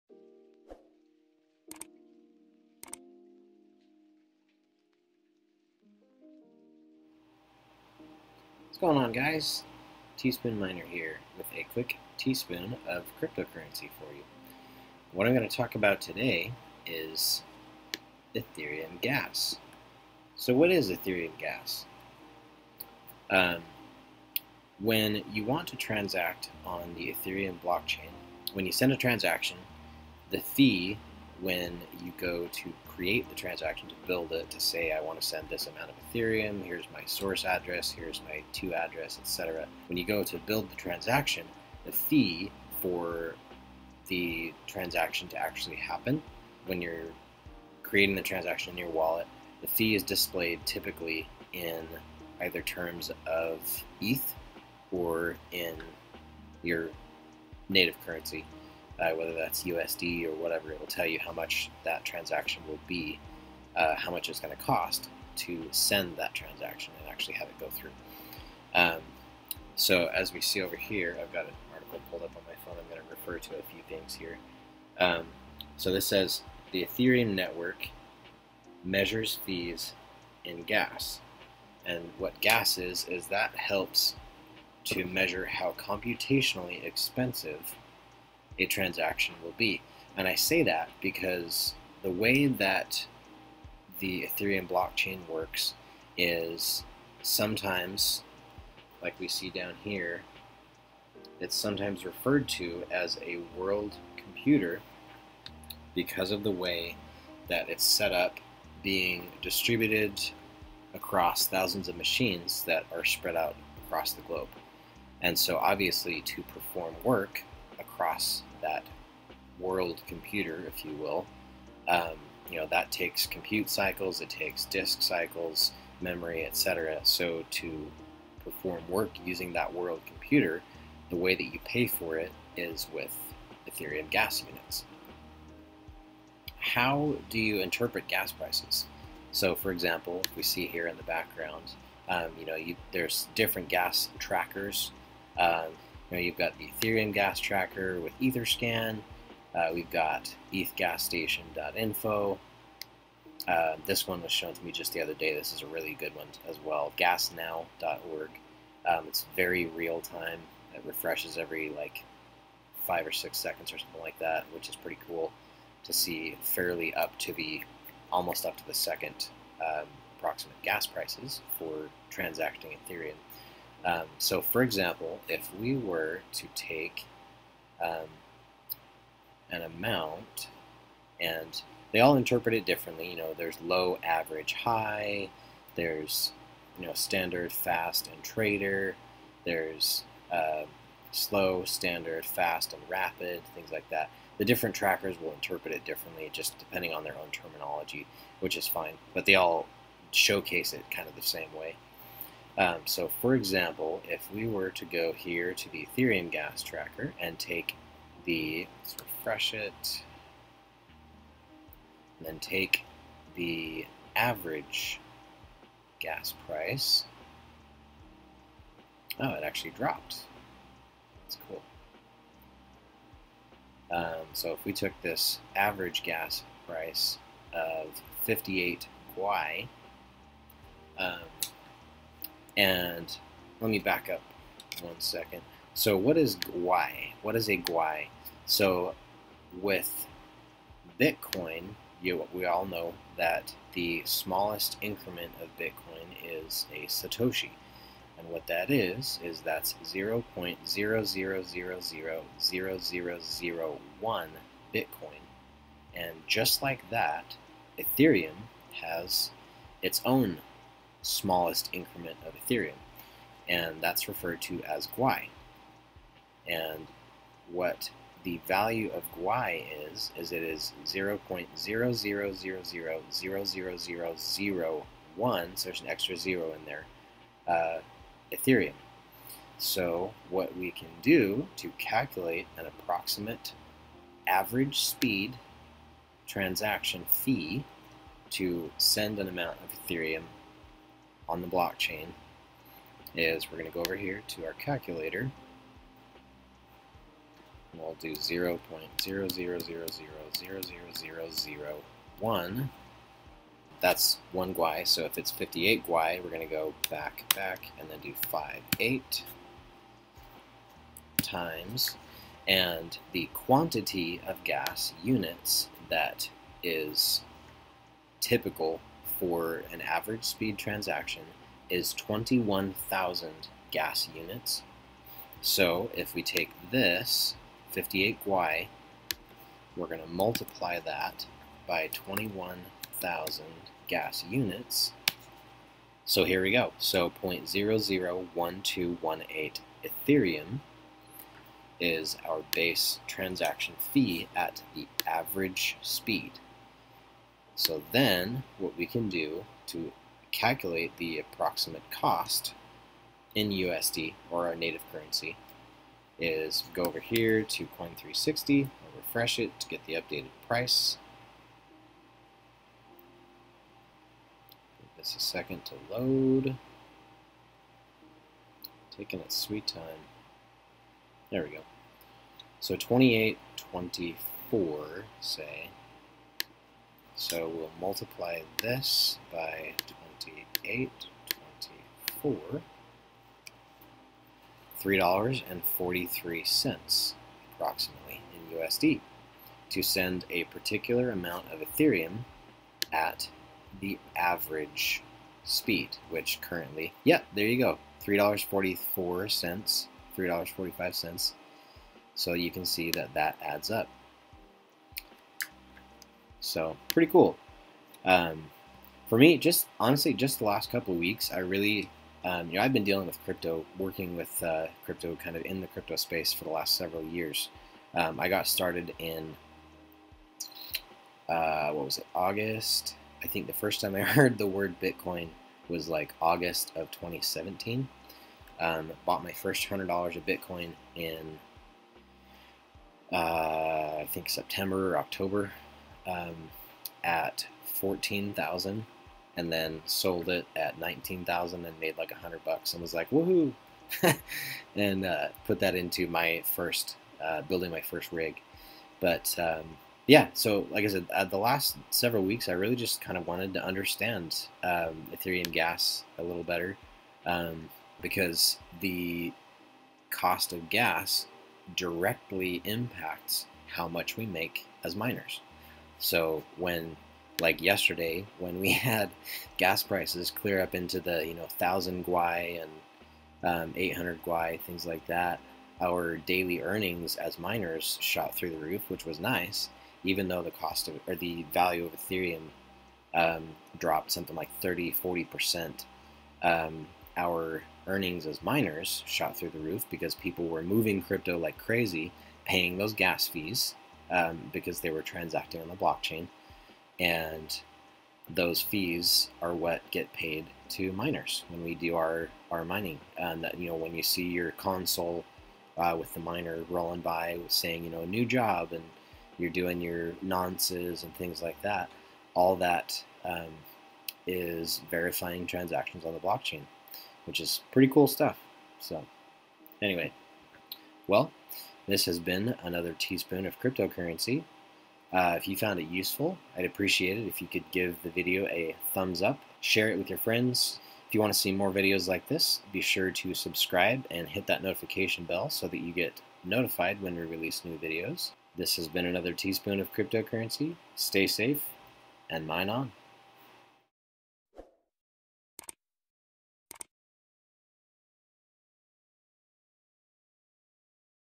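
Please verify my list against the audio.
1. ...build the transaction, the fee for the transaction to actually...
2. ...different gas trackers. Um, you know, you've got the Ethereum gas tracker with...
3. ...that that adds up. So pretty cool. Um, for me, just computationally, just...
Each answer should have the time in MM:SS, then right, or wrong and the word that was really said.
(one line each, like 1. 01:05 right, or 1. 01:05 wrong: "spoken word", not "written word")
1. 00:40 right
2. 02:23 right
3. 06:42 wrong: "honestly", not "computationally".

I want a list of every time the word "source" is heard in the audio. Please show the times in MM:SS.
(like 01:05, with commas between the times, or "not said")
00:37.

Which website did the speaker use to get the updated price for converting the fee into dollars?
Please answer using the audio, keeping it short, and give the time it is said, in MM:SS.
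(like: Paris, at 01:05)
Coin360, at 05:57.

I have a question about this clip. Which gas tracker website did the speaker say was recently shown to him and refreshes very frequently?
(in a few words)
Gasnow.org.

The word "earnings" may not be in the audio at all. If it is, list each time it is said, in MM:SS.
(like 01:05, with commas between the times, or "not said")
07:56, 08:07.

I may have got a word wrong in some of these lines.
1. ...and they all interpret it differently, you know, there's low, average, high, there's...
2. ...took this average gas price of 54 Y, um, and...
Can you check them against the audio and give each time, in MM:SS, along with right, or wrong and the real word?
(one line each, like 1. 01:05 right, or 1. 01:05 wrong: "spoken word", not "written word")
1. 03:01 right
2. 03:44 wrong: "58", not "54".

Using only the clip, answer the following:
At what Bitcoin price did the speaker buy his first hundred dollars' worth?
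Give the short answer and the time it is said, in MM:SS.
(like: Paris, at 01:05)
14,000, at 07:17.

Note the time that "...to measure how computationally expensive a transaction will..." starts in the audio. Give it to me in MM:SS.
01:24.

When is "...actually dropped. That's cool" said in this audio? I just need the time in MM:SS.
03:39.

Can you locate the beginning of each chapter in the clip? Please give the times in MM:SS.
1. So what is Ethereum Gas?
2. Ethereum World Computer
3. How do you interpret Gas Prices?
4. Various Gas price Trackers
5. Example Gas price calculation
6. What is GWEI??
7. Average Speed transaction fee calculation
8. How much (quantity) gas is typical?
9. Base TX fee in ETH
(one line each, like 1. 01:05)
1. 00:20
2. 01:31
3. 02:16
4. 02:53
5. 03:22
6. 03:53
7. 04:39
8. 05:12
9. 05:35.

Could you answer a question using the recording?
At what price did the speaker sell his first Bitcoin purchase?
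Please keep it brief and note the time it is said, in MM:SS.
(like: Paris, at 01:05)
19,000, at 07:20.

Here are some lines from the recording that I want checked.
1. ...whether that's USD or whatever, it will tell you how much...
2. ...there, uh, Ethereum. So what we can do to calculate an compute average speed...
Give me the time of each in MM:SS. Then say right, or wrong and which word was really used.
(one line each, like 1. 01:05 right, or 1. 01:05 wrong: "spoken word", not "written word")
1. 00:59 right
2. 04:36 wrong: "approximate", not "compute".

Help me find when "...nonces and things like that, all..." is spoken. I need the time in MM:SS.
08:30.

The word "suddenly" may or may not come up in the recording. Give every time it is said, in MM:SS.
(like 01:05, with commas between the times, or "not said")
not said.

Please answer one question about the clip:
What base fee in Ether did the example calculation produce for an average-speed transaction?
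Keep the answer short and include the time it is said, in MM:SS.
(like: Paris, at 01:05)
0.001218, at 05:37.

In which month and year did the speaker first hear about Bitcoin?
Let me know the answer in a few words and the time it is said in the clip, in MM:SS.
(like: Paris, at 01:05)
August 2017, at 07:06.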